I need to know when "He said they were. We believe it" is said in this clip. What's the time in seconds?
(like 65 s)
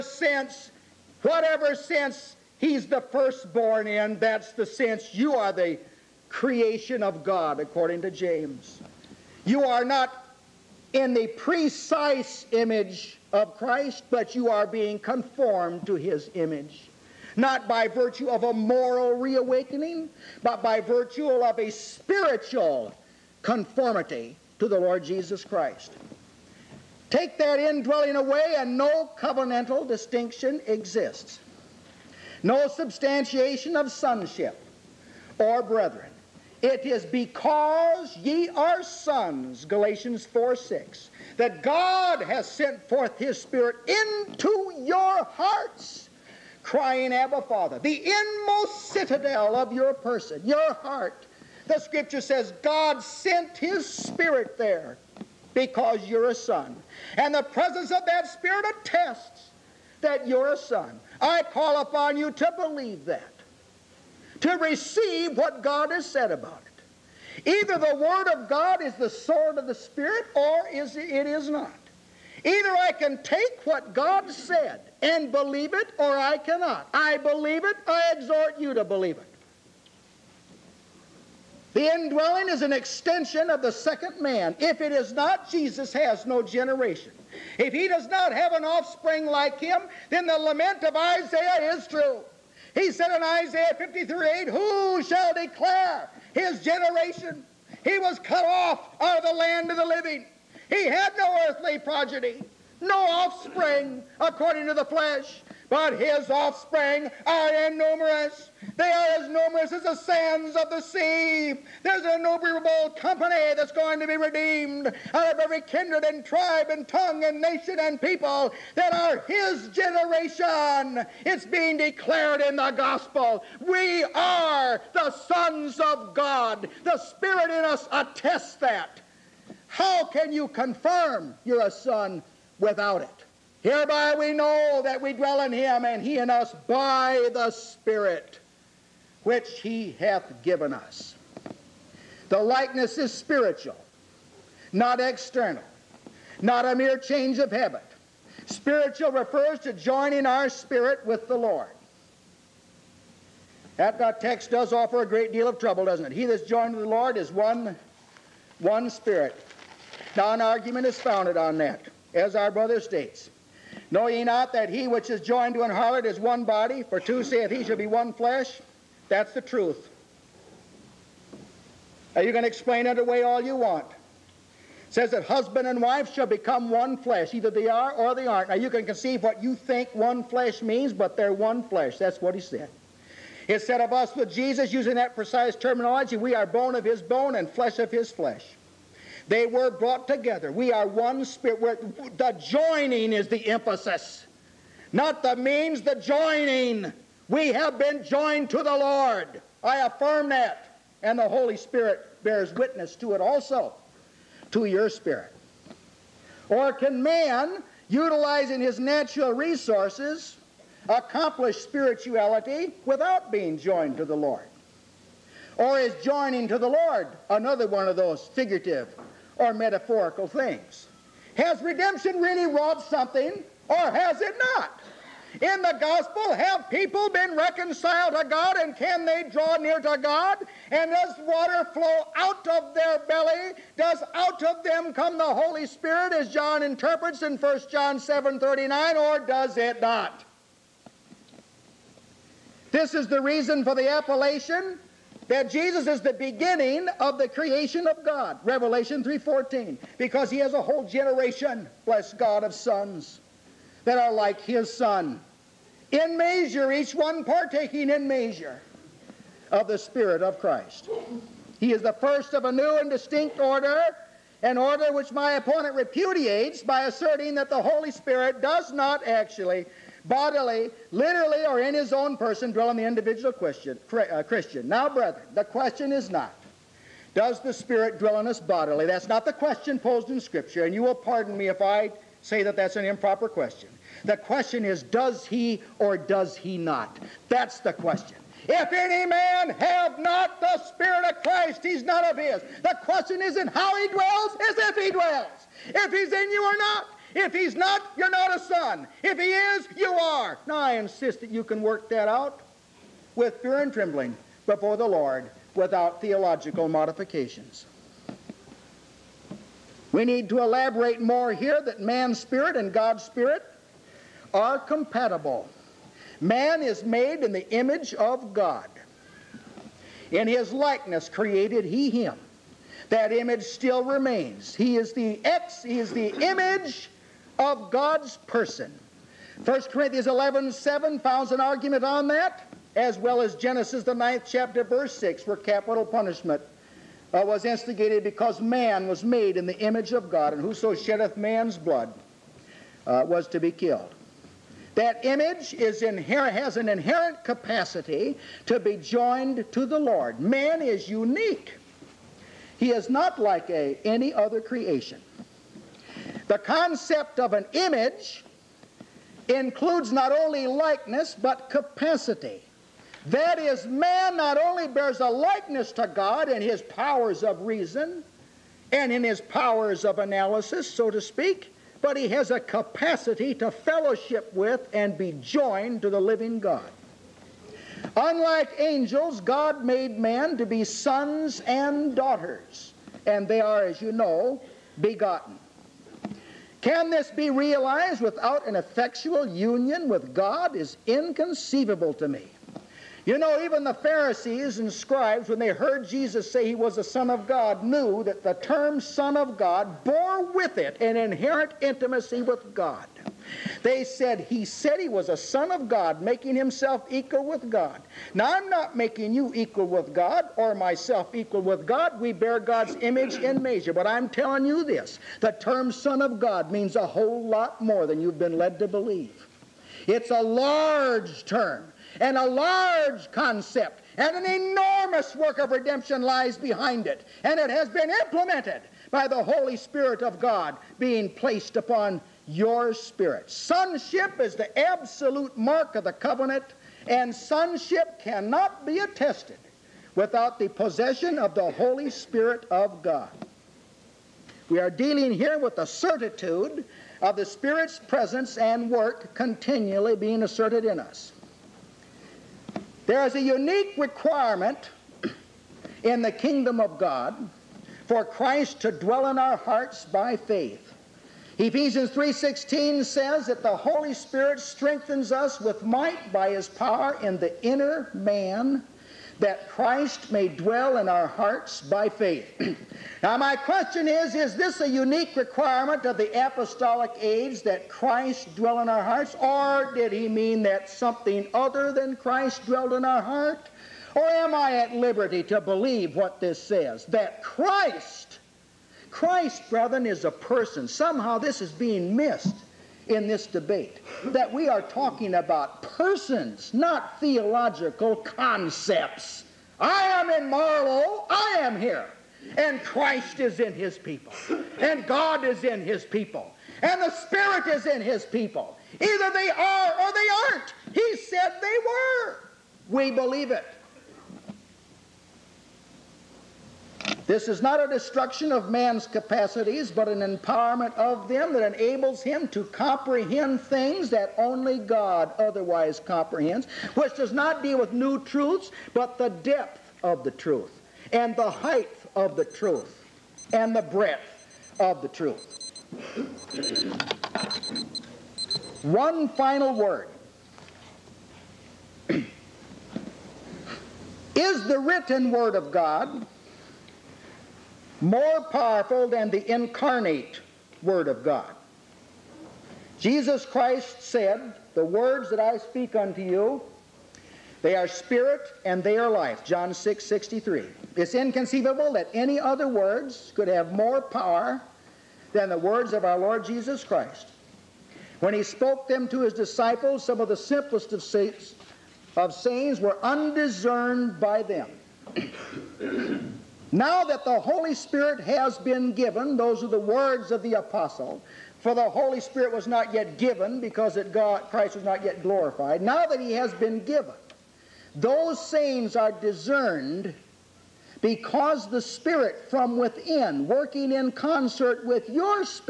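510 s.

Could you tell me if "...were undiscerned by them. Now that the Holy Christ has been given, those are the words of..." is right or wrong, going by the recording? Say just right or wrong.
wrong.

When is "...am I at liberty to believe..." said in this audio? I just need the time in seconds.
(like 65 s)
484 s.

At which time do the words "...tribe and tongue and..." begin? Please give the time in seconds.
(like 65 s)
116 s.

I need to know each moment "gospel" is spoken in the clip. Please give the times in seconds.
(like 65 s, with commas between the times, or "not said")
122 s, 225 s.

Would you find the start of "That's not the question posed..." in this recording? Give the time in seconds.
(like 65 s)
278 s.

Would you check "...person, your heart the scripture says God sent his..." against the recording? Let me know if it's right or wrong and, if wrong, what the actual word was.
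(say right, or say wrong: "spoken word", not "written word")
right.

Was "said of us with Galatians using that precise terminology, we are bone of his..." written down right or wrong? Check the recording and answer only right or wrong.
wrong.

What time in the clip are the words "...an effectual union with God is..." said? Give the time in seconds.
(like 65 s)
388 s.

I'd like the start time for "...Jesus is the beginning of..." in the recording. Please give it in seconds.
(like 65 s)
245 s.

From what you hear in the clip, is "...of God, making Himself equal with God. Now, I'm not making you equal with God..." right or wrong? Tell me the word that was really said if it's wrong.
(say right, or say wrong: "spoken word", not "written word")
right.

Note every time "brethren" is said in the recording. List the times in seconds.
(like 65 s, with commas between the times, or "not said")
35 s, 274 s, 489 s.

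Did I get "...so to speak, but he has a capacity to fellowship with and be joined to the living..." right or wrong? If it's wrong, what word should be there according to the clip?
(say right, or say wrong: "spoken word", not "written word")
right.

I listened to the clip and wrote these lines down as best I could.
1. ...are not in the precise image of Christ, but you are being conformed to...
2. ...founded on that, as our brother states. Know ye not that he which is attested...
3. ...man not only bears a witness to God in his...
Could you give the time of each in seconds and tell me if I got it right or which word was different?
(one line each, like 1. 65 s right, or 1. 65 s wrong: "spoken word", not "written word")
1. 9 s right
2. 160 s wrong: "joined", not "attested"
3. 363 s wrong: "likeness", not "witness".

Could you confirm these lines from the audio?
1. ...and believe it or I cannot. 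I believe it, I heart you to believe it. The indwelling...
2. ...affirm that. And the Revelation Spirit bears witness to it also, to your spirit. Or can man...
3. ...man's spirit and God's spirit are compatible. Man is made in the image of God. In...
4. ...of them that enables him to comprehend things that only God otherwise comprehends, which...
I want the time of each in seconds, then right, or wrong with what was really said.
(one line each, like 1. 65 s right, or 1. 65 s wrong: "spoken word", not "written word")
1. 75 s wrong: "exhort", not "heart"
2. 199 s wrong: "Holy", not "Revelation"
3. 311 s right
4. 520 s right.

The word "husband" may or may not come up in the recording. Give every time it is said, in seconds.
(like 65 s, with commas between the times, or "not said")
175 s.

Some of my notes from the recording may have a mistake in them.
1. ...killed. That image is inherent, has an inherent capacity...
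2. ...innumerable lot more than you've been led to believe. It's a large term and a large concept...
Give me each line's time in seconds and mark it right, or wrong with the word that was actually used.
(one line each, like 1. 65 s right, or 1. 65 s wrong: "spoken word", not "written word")
1. 343 s right
2. 416 s wrong: "whole", not "innumerable".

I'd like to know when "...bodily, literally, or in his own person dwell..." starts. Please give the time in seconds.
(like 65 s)
270 s.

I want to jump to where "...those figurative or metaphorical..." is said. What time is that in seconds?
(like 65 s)
217 s.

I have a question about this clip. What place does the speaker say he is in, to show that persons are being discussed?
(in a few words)
Marlow.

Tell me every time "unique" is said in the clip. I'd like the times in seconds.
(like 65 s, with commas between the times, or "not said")
350 s, 453 s, 474 s.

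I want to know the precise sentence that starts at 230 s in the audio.
And does water flow out of their belly?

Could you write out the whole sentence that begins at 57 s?
And the presence of that spirit attests that you're a son.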